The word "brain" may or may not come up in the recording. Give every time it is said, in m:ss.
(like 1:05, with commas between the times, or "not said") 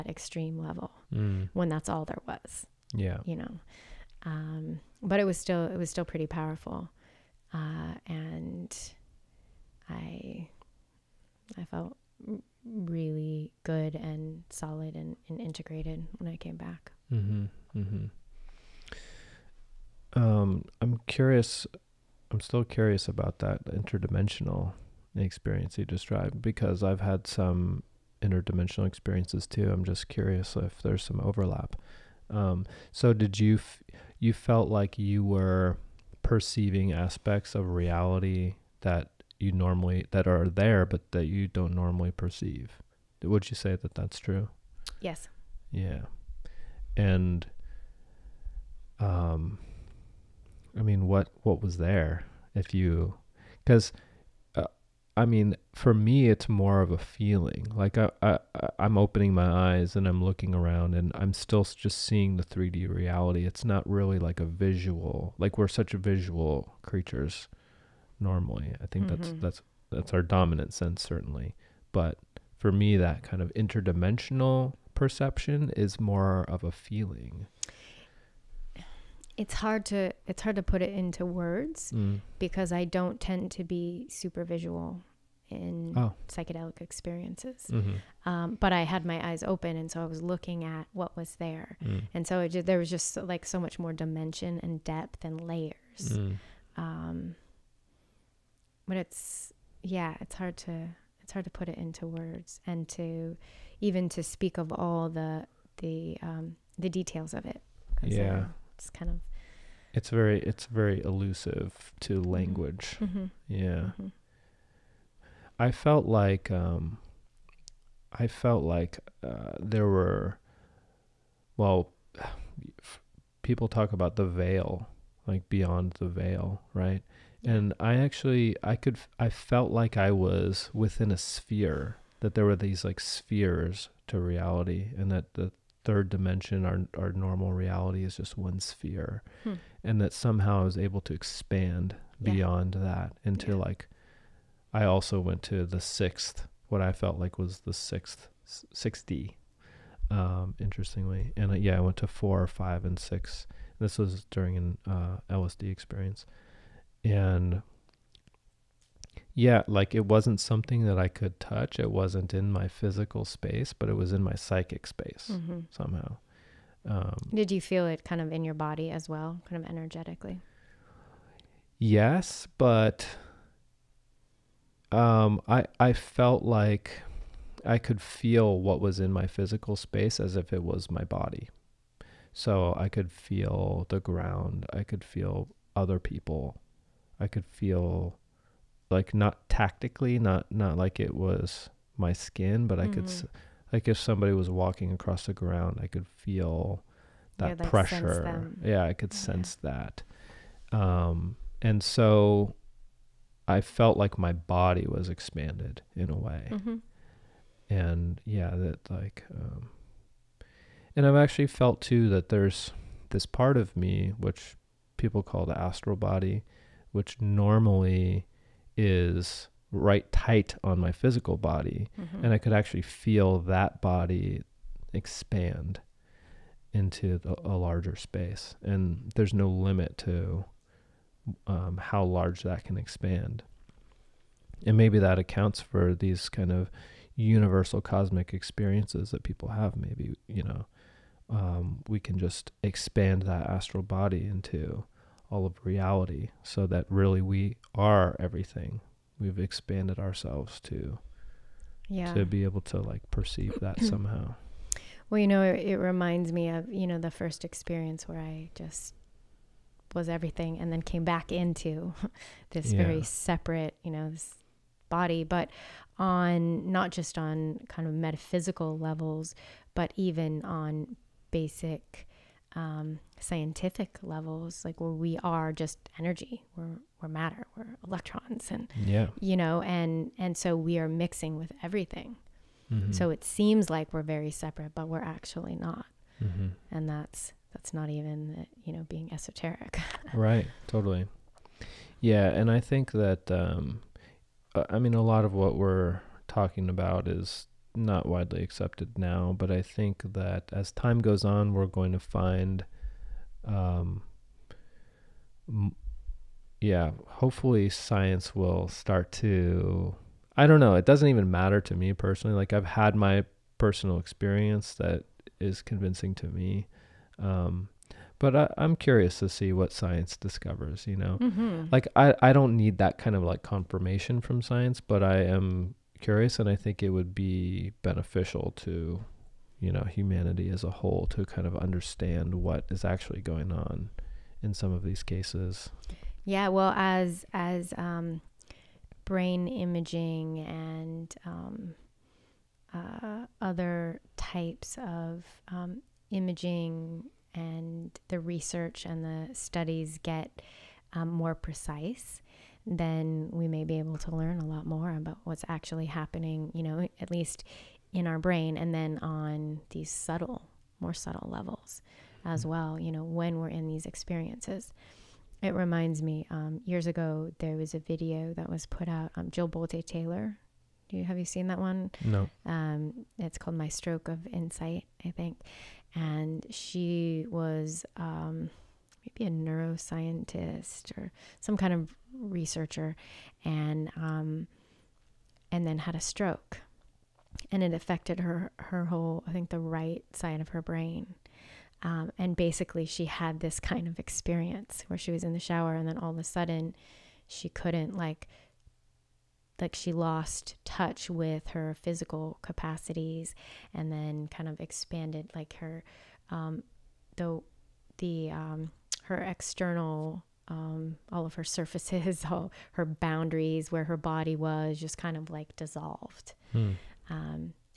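5:39, 5:58, 6:30.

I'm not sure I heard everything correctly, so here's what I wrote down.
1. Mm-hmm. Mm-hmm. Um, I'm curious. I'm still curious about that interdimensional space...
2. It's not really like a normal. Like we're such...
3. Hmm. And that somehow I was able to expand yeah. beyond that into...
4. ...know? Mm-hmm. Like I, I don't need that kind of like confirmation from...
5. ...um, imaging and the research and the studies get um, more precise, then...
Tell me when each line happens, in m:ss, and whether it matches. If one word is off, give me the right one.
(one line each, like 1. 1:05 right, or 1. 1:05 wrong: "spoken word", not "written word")
1. 0:17 wrong: "experience", not "space"
2. 1:03 wrong: "visual", not "normal"
3. 2:19 right
4. 5:20 right
5. 5:45 right.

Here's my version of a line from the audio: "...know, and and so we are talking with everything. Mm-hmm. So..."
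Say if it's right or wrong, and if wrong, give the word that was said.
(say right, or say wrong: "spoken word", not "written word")
wrong: "mixing", not "talking".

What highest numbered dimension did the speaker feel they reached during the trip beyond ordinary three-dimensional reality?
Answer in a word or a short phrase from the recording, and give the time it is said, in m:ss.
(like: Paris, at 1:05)
6D, at 2:28.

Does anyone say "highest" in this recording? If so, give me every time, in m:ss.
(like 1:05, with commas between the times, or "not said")
not said.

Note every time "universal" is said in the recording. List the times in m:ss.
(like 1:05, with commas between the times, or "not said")
3:57.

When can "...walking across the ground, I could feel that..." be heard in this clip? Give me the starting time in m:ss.
3:14.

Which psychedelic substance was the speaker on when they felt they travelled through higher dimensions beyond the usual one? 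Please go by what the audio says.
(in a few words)
LSD.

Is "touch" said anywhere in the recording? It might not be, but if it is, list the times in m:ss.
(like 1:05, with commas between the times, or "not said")
2:41, 6:40.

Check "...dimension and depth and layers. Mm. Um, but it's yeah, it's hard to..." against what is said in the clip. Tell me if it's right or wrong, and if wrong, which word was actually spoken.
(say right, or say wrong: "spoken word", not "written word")
right.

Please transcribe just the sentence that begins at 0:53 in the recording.
Because uh, I mean, for me, it's more of a feeling.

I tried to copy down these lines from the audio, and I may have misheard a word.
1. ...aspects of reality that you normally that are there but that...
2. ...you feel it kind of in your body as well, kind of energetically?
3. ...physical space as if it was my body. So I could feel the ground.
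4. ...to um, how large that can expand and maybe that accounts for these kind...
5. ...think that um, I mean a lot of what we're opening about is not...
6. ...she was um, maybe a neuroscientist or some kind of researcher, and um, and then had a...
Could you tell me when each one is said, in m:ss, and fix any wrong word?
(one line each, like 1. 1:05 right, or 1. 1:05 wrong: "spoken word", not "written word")
1. 0:36 right
2. 2:47 right
3. 2:59 right
4. 3:49 right
5. 4:52 wrong: "talking", not "opening"
6. 6:16 right.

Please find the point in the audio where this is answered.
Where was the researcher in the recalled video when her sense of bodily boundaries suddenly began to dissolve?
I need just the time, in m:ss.
6:35.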